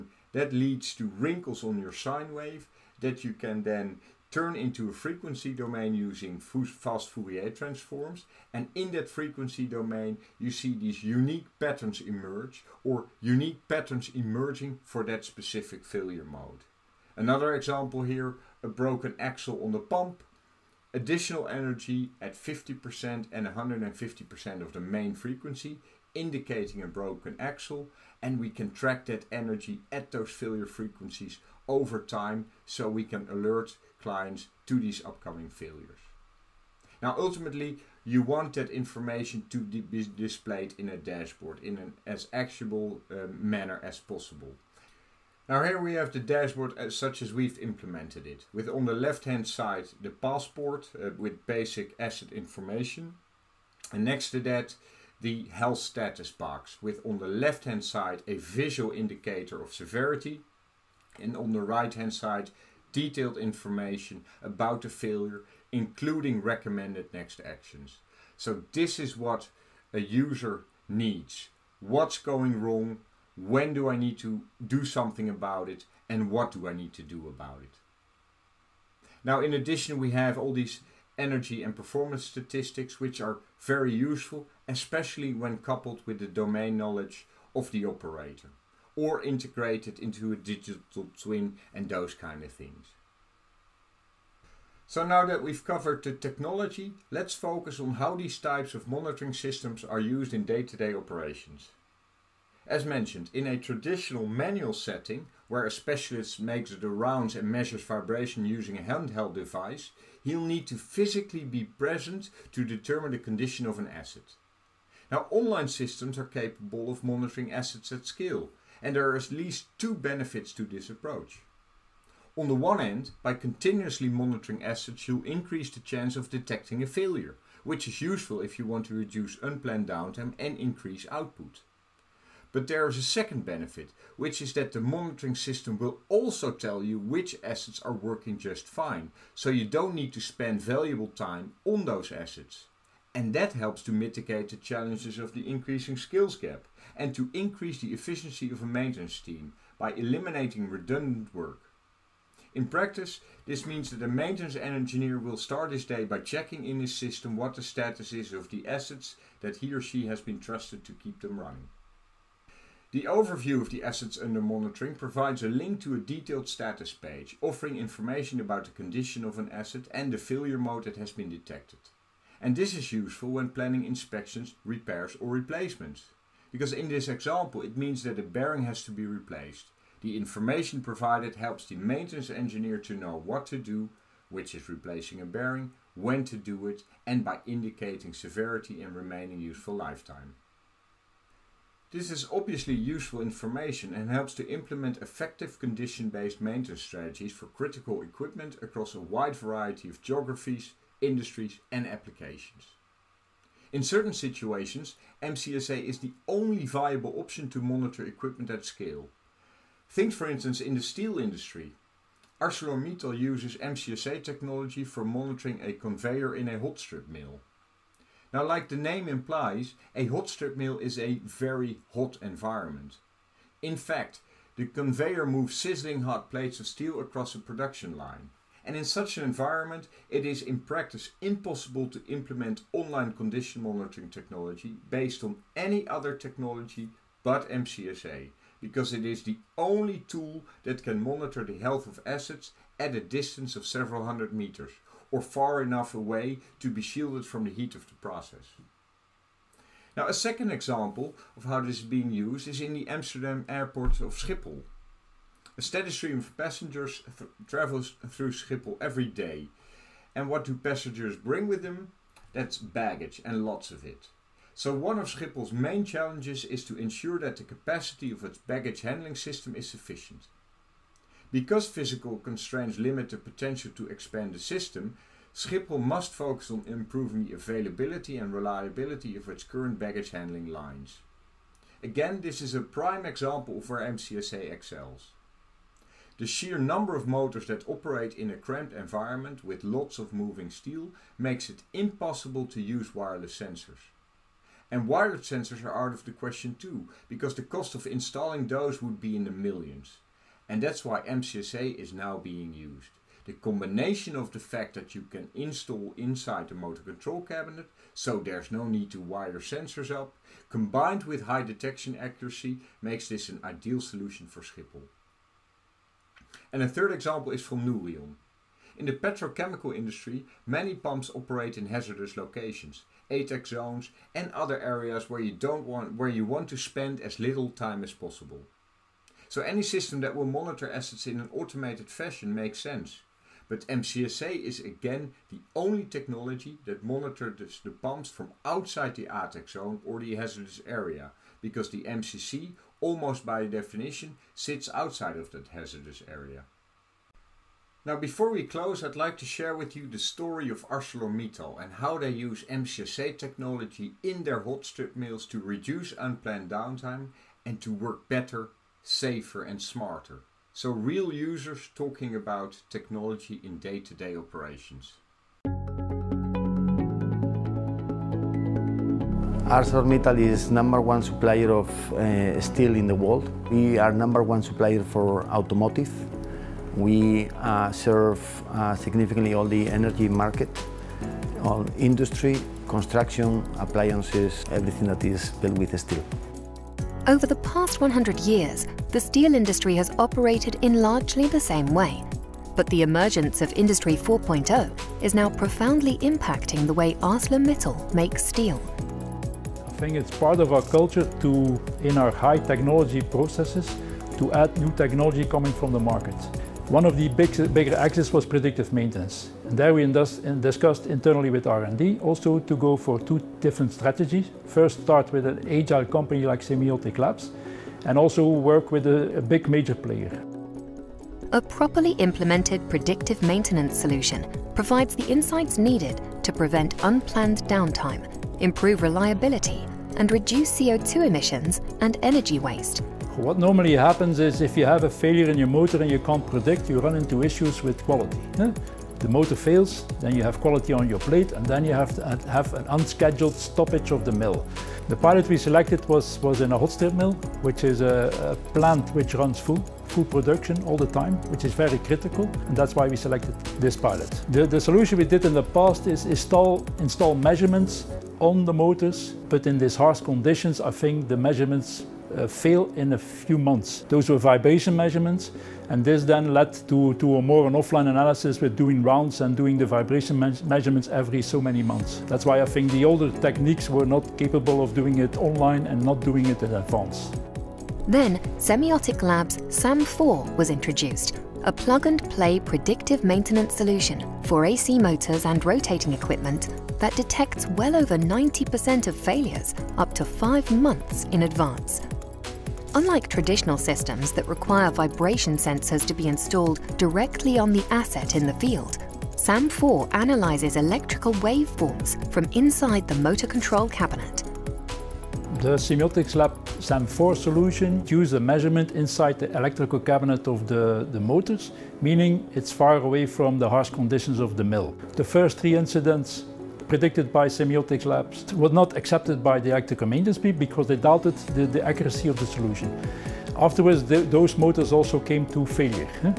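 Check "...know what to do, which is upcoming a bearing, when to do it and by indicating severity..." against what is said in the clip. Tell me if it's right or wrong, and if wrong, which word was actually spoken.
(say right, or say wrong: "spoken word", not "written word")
wrong: "replacing", not "upcoming".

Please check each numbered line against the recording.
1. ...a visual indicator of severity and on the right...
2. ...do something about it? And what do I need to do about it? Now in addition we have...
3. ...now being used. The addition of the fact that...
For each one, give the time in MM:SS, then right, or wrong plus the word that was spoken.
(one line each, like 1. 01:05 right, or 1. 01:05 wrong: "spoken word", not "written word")
1. 00:58 right
2. 01:14 right
3. 05:01 wrong: "combination", not "addition".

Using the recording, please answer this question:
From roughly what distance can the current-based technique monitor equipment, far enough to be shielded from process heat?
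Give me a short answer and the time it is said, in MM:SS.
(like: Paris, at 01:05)
several hundred meters, at 04:03.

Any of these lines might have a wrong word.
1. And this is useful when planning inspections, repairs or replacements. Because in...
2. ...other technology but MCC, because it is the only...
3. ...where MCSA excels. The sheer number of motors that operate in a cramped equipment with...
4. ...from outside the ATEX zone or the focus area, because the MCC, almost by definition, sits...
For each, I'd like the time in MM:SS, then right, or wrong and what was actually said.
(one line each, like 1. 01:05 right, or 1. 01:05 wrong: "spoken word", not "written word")
1. 02:52 right
2. 03:55 wrong: "MCSA", not "MCC"
3. 04:43 wrong: "environment", not "equipment"
4. 05:38 wrong: "hazardous", not "focus".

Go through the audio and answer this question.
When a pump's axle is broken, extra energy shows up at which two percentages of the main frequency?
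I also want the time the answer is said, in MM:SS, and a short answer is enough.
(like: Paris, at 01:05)
50% and 150%, at 00:22.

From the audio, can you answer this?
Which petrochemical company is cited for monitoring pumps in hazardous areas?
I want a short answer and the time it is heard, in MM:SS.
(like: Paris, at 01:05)
Nouryon, at 05:17.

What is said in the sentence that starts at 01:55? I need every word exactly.
Now, online systems are capable of monitoring assets at scale, and there are at least two benefits to this approach.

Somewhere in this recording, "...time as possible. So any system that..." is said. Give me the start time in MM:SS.
05:27.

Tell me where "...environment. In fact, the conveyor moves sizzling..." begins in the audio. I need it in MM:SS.
03:42.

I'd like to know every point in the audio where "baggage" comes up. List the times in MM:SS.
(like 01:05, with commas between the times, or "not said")
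04:22, 04:28, 04:39.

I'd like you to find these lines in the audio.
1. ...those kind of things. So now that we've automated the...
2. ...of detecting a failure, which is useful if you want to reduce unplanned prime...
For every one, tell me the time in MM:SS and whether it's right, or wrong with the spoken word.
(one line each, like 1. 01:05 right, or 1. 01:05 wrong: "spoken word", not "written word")
1. 01:31 wrong: "covered", not "automated"
2. 02:06 wrong: "downtime", not "prime".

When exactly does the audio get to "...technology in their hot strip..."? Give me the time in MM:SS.
05:53.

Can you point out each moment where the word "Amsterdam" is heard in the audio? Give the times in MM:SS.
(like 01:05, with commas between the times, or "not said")
04:12.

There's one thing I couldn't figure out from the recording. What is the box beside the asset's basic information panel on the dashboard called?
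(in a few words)
passport.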